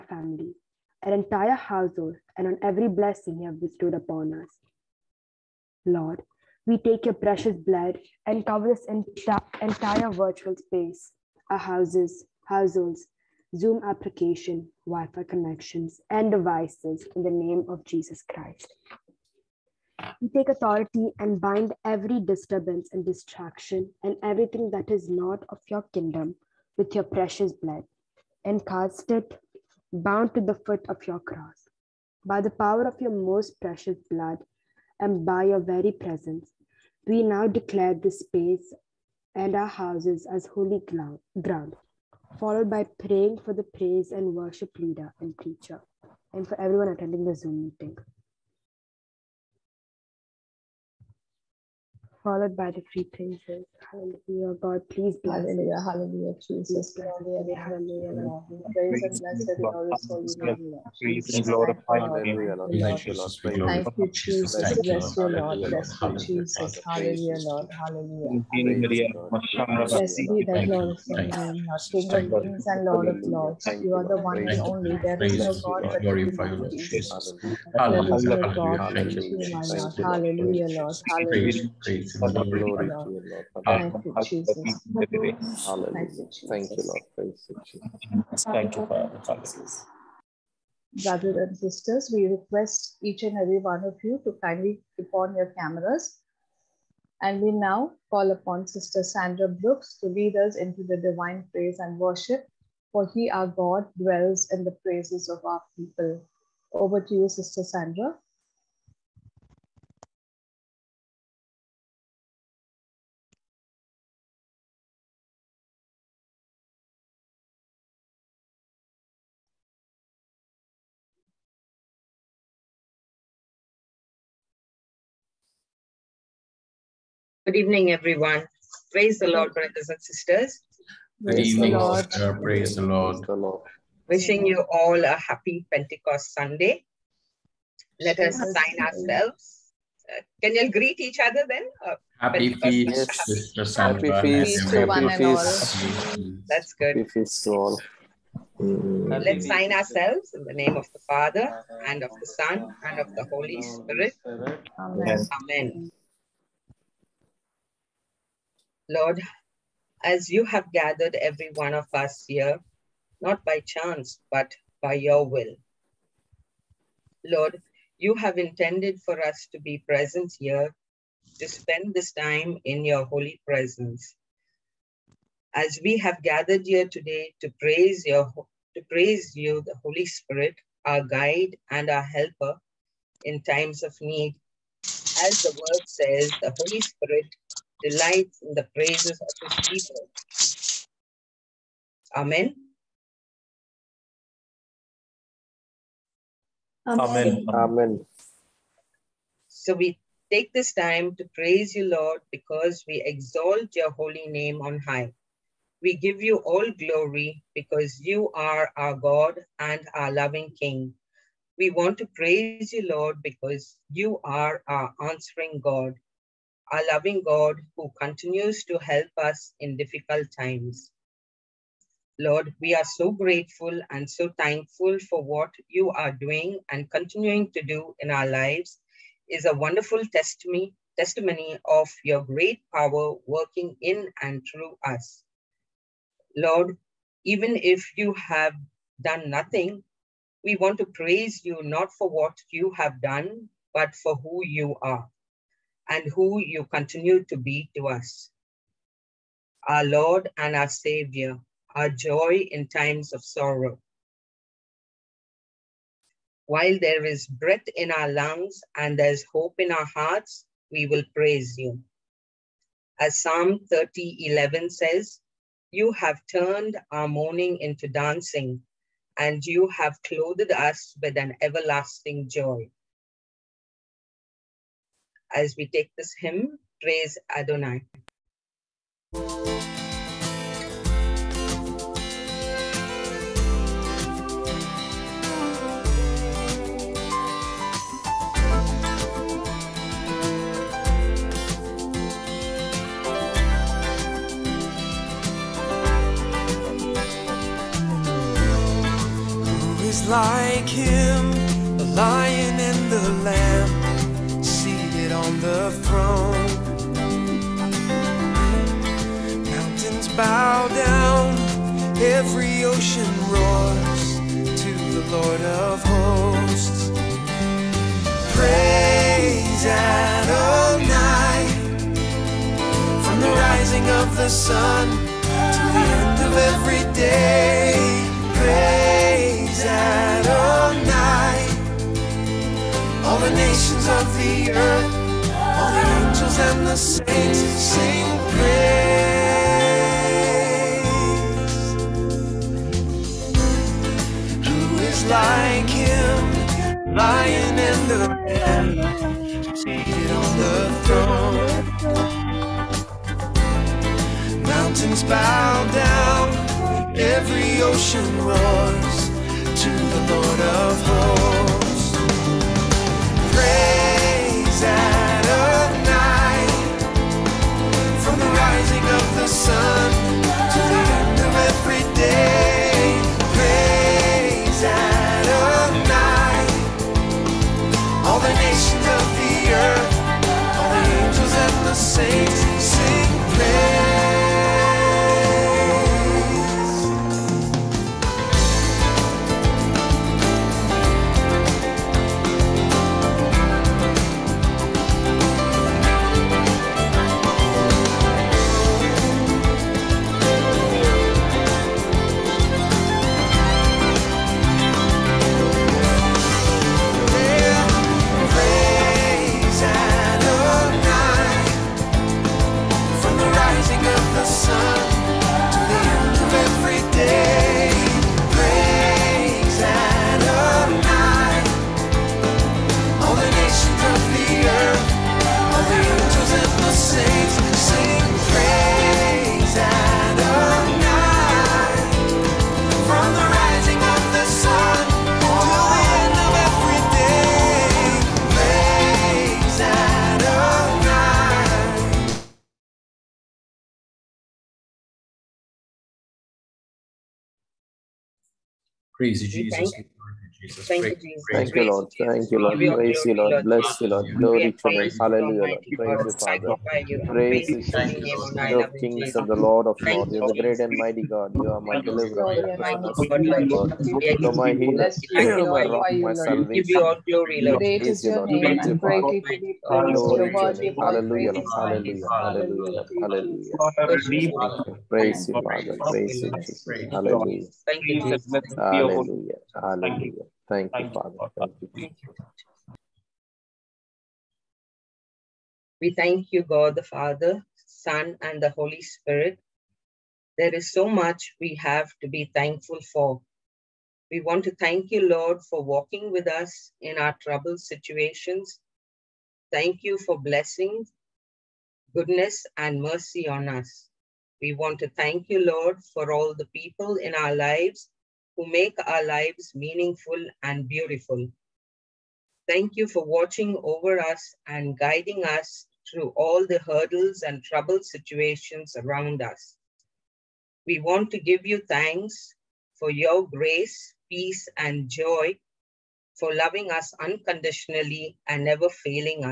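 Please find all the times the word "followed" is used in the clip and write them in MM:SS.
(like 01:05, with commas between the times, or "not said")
00:42, 00:52.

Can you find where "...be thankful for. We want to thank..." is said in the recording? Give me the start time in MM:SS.
08:12.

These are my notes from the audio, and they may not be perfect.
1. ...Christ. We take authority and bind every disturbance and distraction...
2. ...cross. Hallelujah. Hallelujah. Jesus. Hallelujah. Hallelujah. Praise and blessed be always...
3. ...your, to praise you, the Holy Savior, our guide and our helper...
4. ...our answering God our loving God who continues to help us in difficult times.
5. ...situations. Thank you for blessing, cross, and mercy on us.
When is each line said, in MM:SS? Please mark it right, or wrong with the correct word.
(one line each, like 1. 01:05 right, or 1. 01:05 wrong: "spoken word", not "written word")
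1. 00:18 right
2. 00:55 wrong: "bless", not "cross"
3. 02:58 wrong: "Spirit", not "Savior"
4. 03:34 right
5. 08:17 wrong: "goodness", not "cross".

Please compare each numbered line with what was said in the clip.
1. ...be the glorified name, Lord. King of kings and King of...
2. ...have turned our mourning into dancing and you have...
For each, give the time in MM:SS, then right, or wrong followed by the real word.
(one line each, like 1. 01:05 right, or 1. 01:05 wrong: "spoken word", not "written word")
1. 01:10 wrong: "Lord", not "King"
2. 04:25 right.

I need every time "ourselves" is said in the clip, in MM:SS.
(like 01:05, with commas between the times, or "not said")
02:18, 02:29.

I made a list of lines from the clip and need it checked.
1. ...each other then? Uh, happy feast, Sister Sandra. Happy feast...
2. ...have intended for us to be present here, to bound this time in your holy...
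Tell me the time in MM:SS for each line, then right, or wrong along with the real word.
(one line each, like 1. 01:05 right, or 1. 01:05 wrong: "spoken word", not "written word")
1. 02:21 right
2. 02:48 wrong: "spend", not "bound".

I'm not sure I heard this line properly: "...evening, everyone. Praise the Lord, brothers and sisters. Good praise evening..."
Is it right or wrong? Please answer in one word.
right.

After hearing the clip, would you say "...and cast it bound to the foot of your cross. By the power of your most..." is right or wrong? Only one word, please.
right.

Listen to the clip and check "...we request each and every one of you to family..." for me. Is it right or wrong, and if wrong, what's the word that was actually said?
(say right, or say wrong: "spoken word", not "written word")
wrong: "kindly", not "family".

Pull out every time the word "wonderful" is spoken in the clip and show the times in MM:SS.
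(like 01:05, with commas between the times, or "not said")
03:49.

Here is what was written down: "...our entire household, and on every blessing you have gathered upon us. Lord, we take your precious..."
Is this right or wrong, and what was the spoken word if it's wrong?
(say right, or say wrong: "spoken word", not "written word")
wrong: "bestowed", not "gathered".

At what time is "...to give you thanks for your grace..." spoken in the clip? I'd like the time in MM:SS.
08:41.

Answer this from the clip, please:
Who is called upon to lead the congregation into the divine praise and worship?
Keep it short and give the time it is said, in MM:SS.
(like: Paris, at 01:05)
Sister Sandra Brooks, at 01:38.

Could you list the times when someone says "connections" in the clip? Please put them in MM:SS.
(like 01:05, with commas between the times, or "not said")
00:15.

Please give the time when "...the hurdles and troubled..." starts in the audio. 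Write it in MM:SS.
08:36.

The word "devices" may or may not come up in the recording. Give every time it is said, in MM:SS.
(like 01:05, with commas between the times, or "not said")
00:16.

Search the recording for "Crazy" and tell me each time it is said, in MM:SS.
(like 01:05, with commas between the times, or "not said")
07:29.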